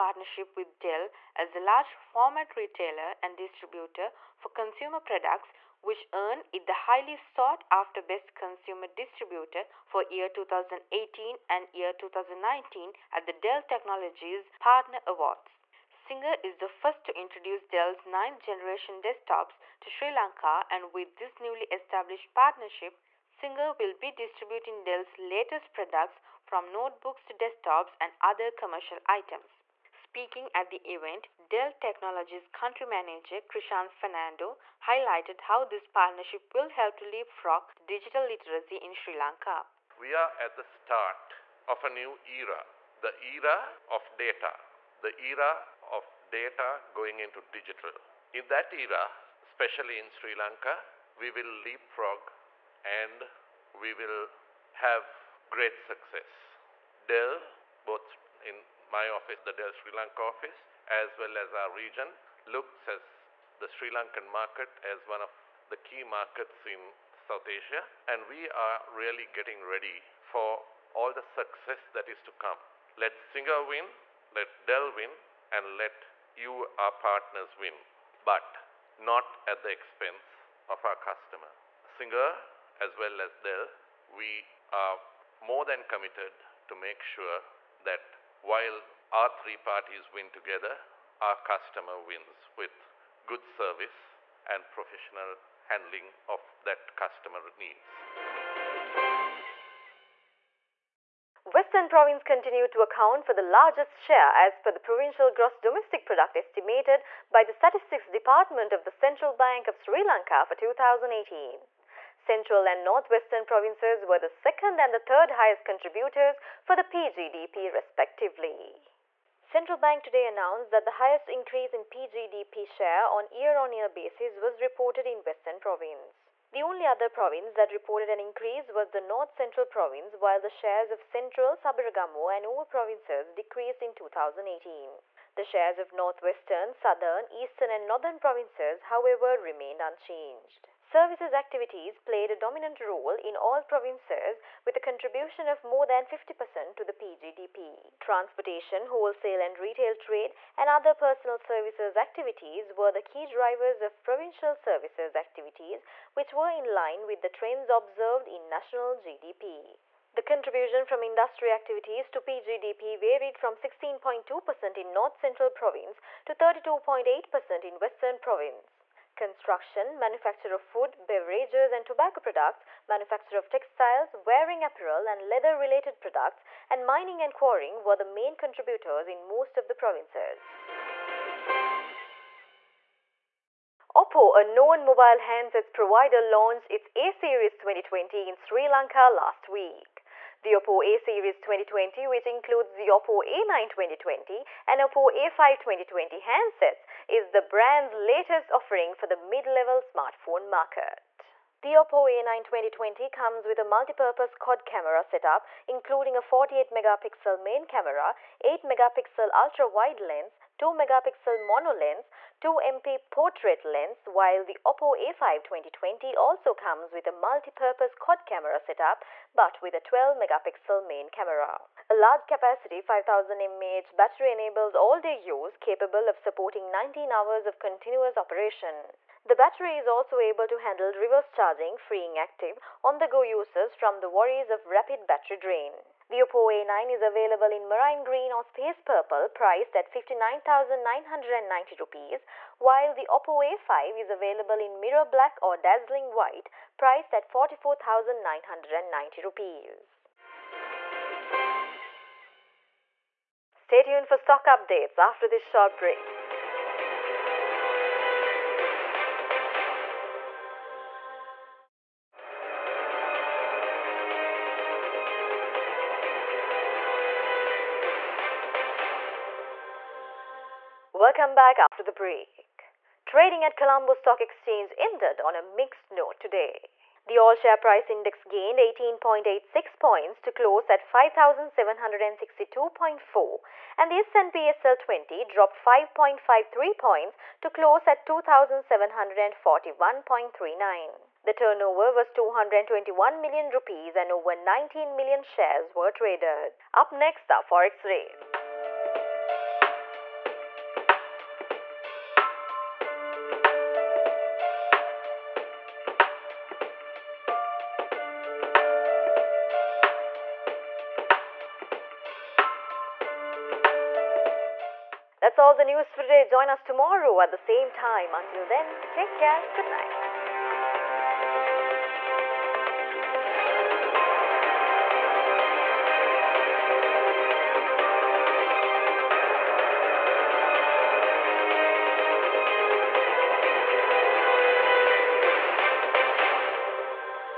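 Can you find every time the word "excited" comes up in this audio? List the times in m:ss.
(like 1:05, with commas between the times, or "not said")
not said.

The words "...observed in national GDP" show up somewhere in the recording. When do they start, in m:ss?
2:37.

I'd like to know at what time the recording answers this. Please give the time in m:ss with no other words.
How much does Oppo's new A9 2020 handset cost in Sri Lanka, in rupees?
3:59.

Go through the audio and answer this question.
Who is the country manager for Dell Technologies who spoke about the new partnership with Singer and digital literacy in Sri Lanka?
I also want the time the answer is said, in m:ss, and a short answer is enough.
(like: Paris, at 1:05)
Krishan Fernando, at 0:33.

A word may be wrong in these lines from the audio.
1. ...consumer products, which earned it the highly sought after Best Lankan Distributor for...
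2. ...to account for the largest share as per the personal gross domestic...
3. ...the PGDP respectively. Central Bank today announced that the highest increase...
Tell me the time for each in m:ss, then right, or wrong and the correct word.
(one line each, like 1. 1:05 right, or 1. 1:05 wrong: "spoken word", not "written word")
1. 0:04 wrong: "Consumer", not "Lankan"
2. 1:42 wrong: "provincial", not "personal"
3. 1:56 right.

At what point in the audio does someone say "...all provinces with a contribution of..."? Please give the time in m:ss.
2:23.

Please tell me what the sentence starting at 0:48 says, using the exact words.
In that era, especially in Sri Lanka, we will leapfrog and we will have great success.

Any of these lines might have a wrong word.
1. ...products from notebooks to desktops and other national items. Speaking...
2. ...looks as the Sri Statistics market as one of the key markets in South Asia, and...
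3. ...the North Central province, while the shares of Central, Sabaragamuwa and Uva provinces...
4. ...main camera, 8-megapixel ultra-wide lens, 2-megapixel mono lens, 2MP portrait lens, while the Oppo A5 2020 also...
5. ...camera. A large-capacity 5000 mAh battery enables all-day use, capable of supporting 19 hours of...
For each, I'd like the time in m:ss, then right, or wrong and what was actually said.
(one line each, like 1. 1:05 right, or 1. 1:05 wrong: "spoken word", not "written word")
1. 0:25 wrong: "commercial", not "national"
2. 1:02 wrong: "Lankan", not "Statistics"
3. 2:08 right
4. 3:27 right
5. 3:41 right.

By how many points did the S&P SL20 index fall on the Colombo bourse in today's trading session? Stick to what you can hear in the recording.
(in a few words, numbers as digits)
5.53.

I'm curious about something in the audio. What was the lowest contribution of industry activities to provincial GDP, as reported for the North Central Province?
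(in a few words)
16.2%.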